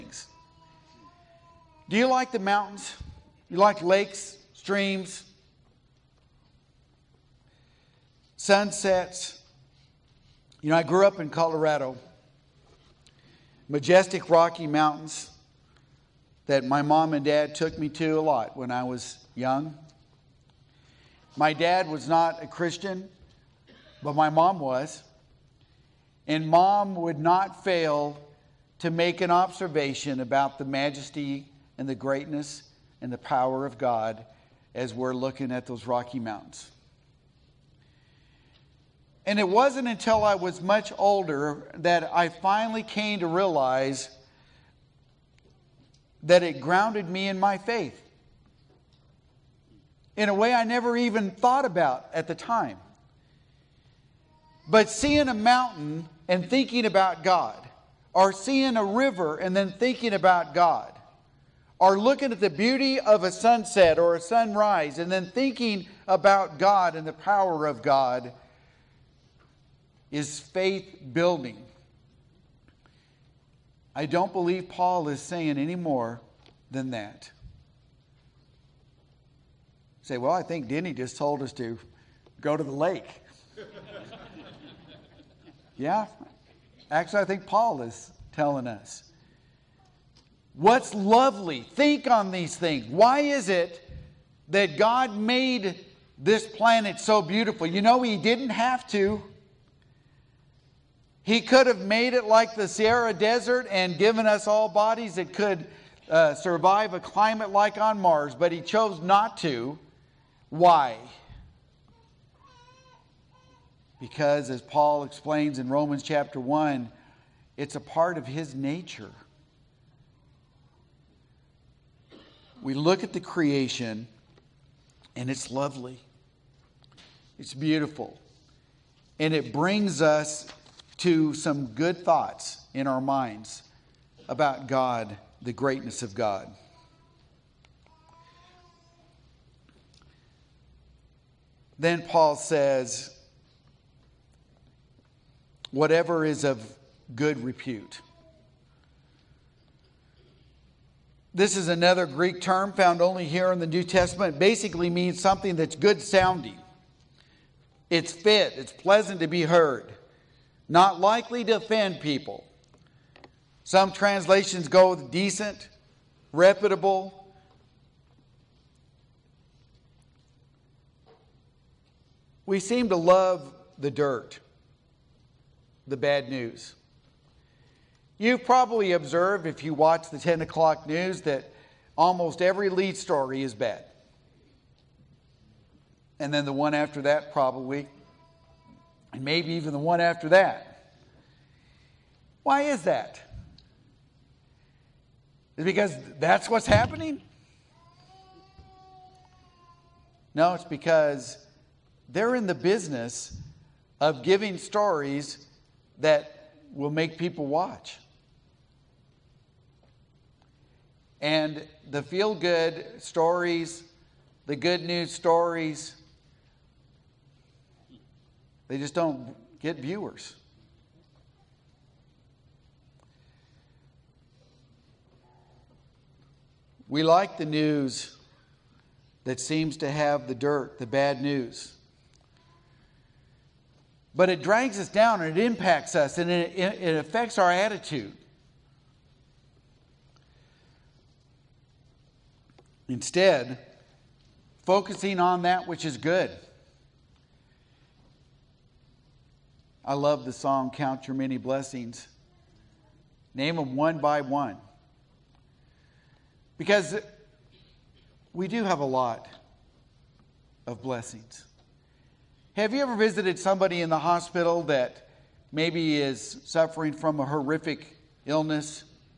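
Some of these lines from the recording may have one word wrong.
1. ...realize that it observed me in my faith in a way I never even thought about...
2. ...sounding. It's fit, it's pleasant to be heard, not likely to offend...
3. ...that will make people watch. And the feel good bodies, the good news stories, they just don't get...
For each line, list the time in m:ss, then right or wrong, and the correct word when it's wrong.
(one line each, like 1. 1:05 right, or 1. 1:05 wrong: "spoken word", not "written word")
1. 0:43 wrong: "grounded", not "observed"
2. 2:36 right
3. 3:25 wrong: "stories", not "bodies".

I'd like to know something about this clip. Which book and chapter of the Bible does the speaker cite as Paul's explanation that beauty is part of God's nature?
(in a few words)
Romans chapter 1.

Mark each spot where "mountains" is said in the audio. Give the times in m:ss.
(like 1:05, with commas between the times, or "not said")
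0:02, 0:14, 0:36, 0:55.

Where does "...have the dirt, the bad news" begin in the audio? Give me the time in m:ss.
3:49.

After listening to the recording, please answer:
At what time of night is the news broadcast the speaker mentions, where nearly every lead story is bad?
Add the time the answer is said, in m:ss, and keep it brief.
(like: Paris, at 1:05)
10 o'clock, at 3:00.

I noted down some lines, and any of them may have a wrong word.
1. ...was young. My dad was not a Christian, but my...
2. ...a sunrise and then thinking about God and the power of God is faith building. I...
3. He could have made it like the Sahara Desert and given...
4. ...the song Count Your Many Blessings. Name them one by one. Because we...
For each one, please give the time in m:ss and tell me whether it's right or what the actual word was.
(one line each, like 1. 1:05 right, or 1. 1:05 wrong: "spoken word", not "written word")
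1. 0:18 right
2. 1:04 right
3. 1:41 right
4. 4:10 right.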